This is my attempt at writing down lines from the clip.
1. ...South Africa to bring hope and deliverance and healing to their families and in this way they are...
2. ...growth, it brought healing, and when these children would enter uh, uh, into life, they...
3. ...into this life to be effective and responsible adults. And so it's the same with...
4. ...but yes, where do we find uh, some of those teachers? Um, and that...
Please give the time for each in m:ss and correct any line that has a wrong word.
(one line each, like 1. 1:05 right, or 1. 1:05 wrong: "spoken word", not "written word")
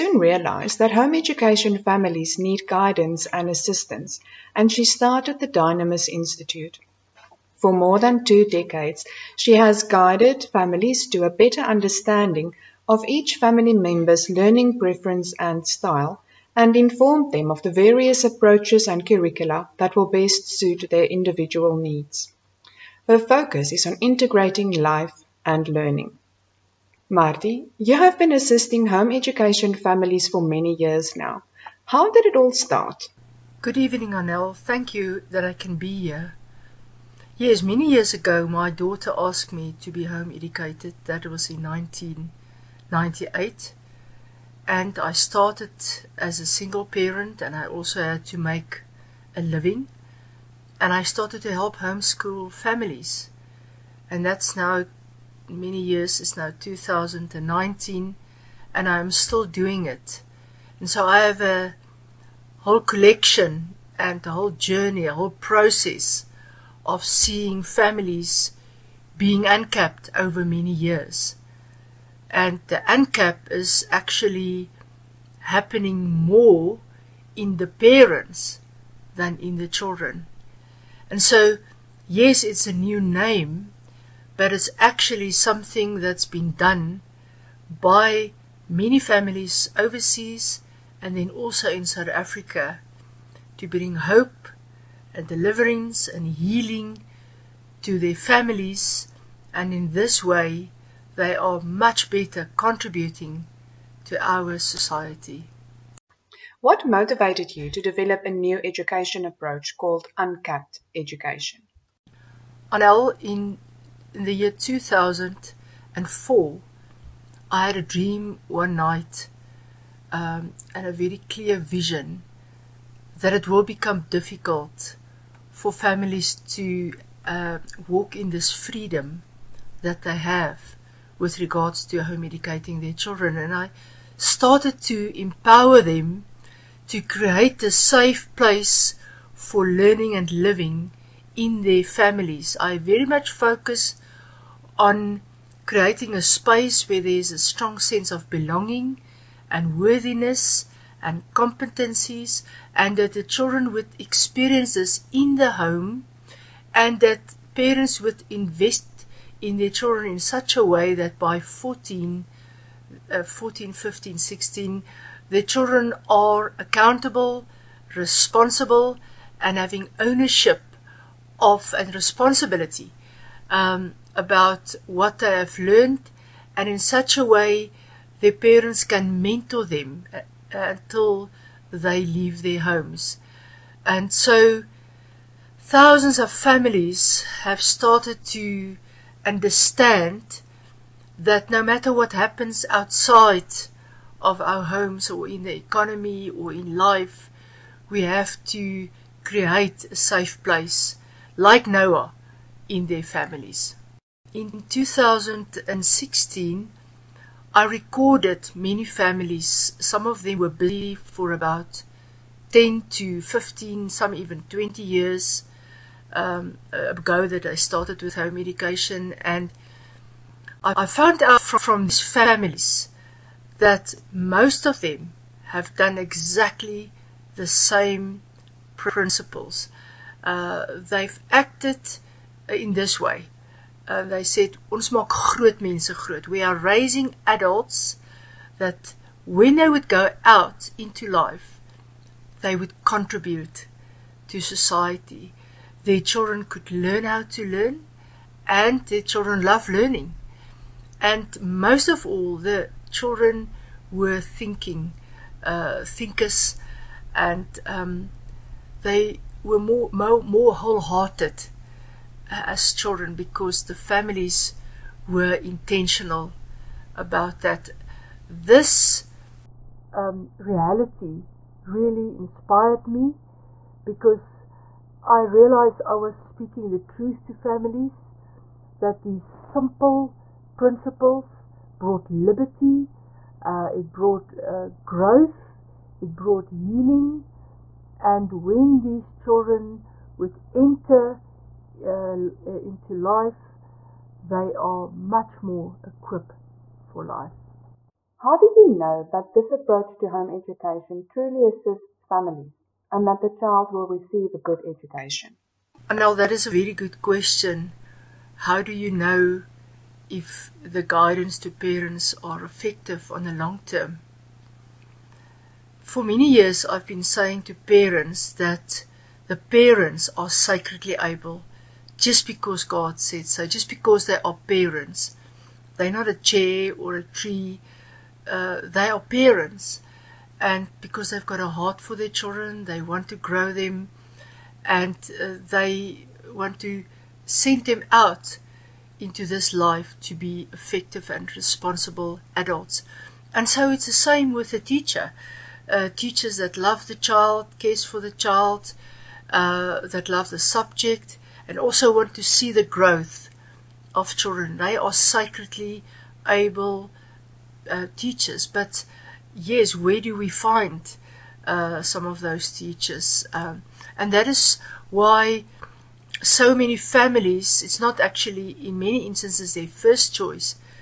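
1. 1:31 right
2. 4:44 right
3. 5:38 right
4. 5:58 right.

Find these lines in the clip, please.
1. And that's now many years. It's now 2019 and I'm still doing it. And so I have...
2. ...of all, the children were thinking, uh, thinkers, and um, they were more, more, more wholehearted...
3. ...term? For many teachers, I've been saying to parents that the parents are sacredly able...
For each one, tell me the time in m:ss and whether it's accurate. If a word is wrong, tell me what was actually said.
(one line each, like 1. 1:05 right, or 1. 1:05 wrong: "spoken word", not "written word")
1. 0:54 right
2. 4:11 right
3. 5:13 wrong: "years", not "teachers".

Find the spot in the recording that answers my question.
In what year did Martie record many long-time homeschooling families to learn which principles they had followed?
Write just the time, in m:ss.
3:24.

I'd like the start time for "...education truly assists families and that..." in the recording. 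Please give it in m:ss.
5:00.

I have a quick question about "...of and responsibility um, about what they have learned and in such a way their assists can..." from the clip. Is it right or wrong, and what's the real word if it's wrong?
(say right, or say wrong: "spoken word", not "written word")
wrong: "parents", not "assists".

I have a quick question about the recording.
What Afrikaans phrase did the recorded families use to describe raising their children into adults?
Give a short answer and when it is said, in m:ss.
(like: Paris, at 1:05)
ons maak groot mense groot, at 3:54.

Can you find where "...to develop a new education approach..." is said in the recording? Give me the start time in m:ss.
1:47.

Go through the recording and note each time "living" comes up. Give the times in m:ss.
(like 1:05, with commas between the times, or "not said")
0:49, 2:20.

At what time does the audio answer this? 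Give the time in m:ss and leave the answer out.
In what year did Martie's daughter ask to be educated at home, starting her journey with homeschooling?
0:41.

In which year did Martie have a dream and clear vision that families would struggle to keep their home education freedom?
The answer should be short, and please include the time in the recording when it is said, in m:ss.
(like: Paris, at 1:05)
2004, at 1:54.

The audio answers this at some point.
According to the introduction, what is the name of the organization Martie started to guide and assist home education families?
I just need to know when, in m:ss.
0:05.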